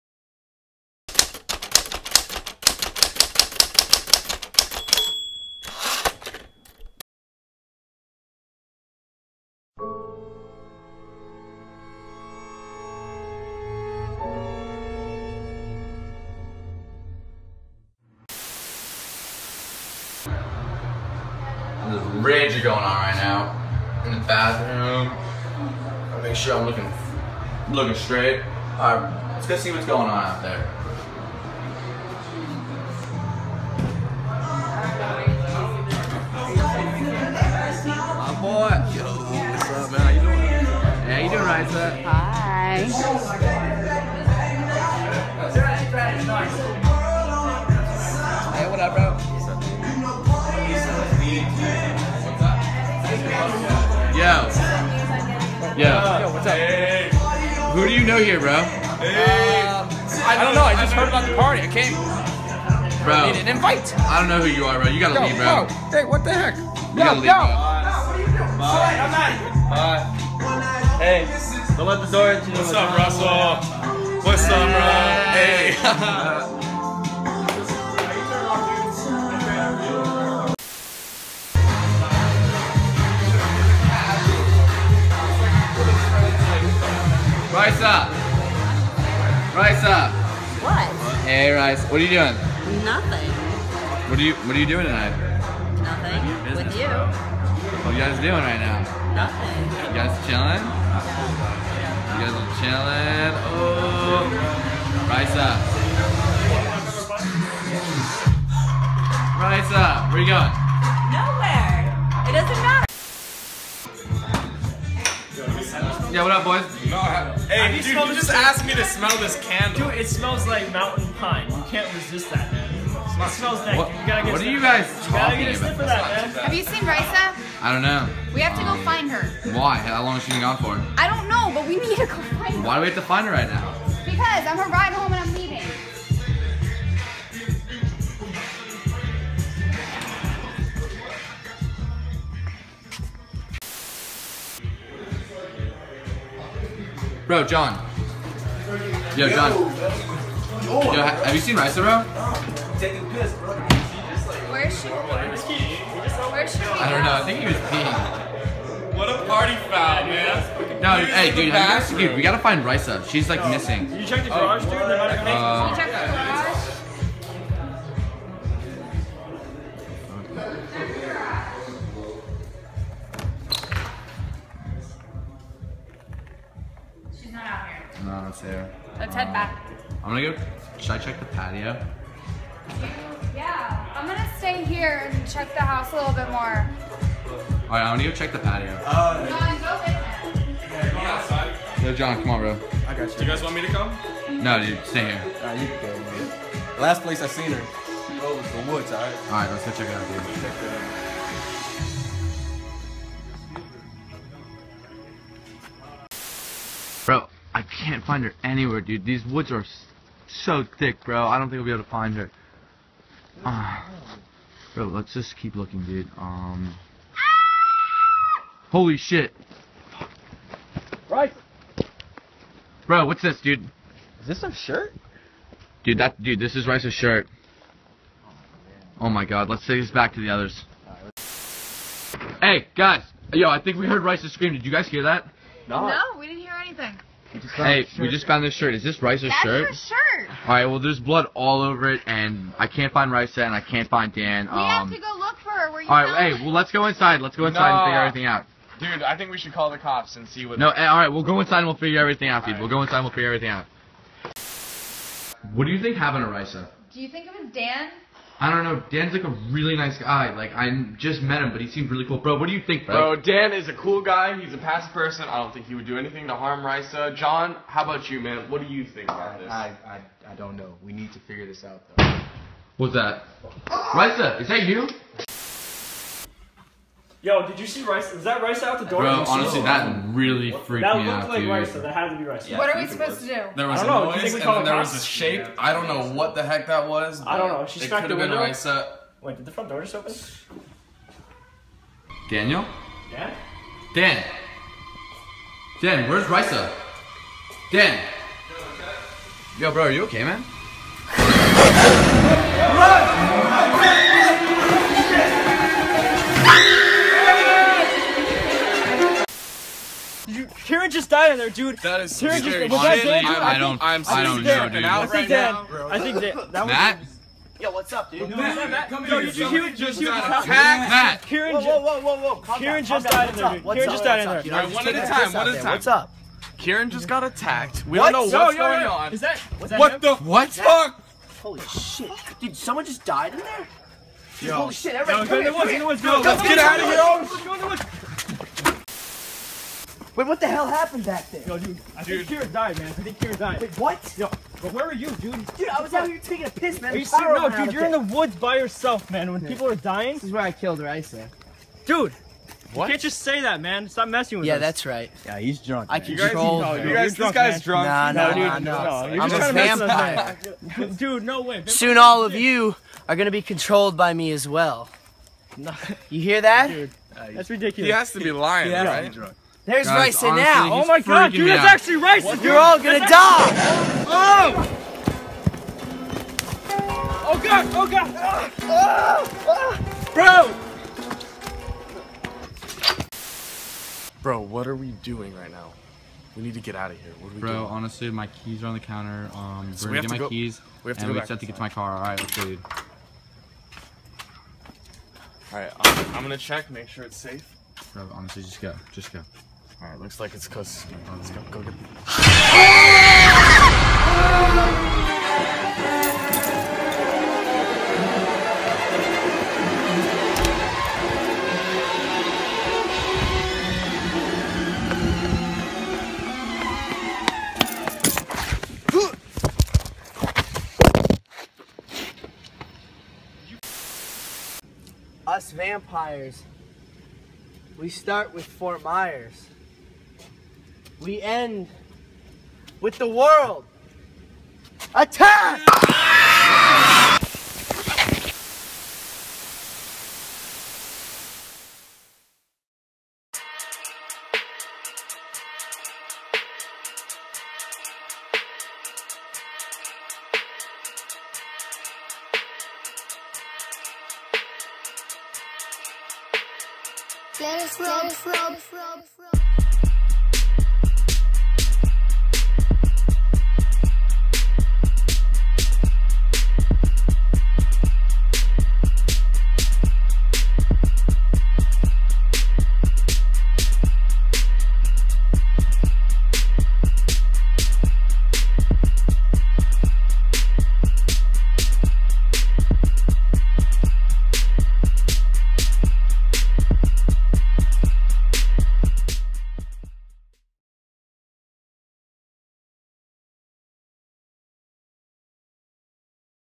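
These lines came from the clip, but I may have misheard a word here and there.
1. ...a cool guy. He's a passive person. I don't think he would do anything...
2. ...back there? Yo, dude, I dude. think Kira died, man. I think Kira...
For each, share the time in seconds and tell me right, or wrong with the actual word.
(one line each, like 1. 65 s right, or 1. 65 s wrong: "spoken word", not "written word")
1. 263 s right
2. 341 s right.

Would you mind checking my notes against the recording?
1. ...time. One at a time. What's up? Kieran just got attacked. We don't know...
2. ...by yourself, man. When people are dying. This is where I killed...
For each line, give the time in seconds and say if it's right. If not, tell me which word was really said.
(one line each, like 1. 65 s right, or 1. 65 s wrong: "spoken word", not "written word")
1. 325 s right
2. 348 s right.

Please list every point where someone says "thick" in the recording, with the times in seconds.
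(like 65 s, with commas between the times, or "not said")
210 s.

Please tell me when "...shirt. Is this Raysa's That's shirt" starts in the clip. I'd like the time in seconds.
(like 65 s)
238 s.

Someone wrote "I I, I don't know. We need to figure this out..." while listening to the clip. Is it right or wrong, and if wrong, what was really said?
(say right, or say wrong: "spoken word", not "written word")
right.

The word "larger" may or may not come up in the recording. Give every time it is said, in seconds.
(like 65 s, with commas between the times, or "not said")
not said.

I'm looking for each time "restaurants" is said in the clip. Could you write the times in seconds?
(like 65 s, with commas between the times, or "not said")
178 s.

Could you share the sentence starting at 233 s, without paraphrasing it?
Yo, I think we heard Raysa's scream.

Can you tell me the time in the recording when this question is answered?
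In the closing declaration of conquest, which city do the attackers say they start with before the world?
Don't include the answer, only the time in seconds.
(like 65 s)
428 s.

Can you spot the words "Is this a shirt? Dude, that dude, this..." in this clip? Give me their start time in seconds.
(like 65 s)
224 s.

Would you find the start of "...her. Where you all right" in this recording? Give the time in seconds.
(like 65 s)
245 s.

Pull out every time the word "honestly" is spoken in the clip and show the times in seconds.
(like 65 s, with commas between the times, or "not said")
279 s, 387 s, 398 s.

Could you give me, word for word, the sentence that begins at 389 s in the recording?
Um, so we're gonna get my go, keys.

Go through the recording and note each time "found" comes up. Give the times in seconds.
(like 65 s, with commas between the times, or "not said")
238 s.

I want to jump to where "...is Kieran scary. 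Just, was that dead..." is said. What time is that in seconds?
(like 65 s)
312 s.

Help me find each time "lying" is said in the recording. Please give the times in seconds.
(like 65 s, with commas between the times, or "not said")
368 s.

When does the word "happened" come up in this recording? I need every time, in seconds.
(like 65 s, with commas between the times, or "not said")
255 s, 340 s.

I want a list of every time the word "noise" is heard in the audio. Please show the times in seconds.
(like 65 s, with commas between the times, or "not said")
284 s.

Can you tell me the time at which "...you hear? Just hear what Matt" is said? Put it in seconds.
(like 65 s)
319 s.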